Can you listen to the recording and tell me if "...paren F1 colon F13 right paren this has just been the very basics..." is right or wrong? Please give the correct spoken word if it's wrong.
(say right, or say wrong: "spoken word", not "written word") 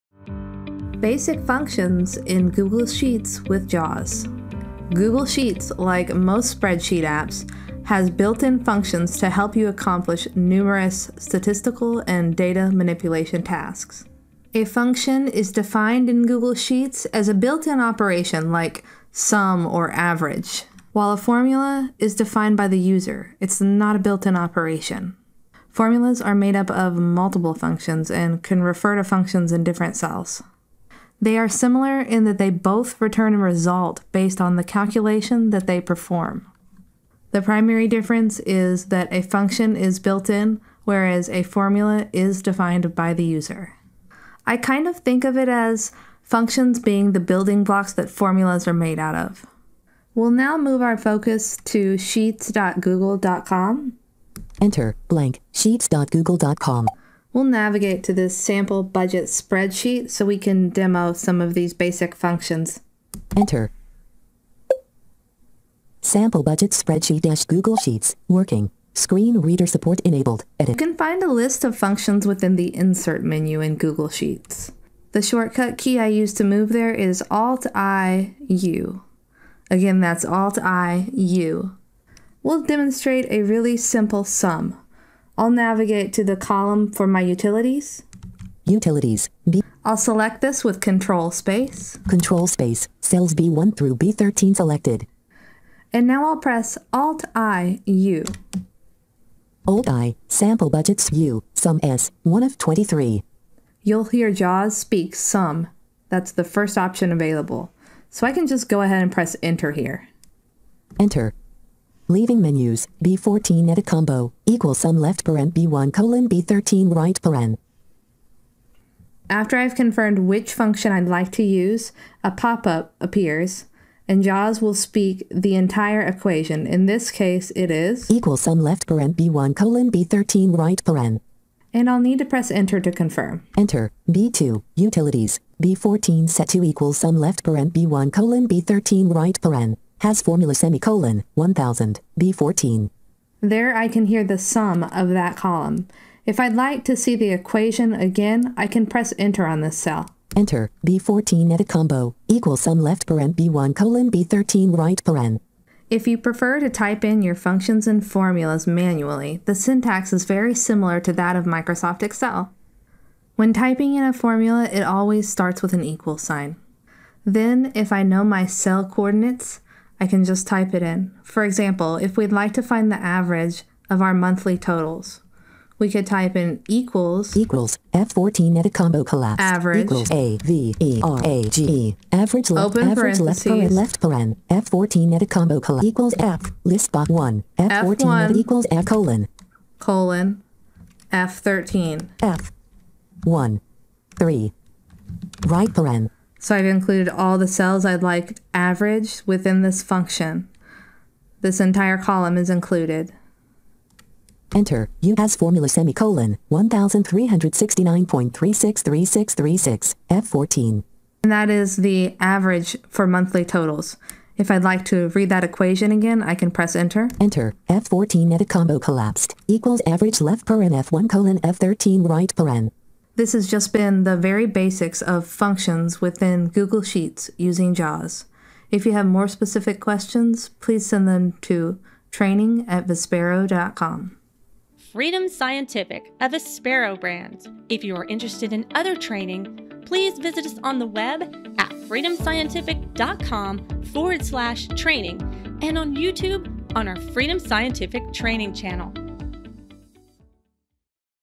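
right.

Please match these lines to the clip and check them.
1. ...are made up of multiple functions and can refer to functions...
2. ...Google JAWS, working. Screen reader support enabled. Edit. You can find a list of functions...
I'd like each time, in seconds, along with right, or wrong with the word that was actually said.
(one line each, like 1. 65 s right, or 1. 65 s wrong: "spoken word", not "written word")
1. 26 s right
2. 67 s wrong: "Sheets", not "JAWS".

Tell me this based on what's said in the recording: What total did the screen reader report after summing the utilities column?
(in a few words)
1000.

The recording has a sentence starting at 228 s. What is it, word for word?
If you have more specific questions, please send them to training at vispero.com.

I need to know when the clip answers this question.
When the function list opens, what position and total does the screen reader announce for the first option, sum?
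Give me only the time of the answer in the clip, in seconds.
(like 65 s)
102 s.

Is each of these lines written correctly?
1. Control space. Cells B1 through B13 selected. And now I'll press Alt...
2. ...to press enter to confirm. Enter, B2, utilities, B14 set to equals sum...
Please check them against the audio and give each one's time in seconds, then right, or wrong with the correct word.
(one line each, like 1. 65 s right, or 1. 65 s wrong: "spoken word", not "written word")
1. 92 s right
2. 132 s right.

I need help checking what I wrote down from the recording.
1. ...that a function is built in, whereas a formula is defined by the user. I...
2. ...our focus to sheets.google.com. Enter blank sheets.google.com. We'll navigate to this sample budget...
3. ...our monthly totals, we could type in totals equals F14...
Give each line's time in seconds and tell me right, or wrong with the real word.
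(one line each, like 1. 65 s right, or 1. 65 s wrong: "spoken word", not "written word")
1. 38 s right
2. 50 s right
3. 174 s wrong: "equals", not "totals".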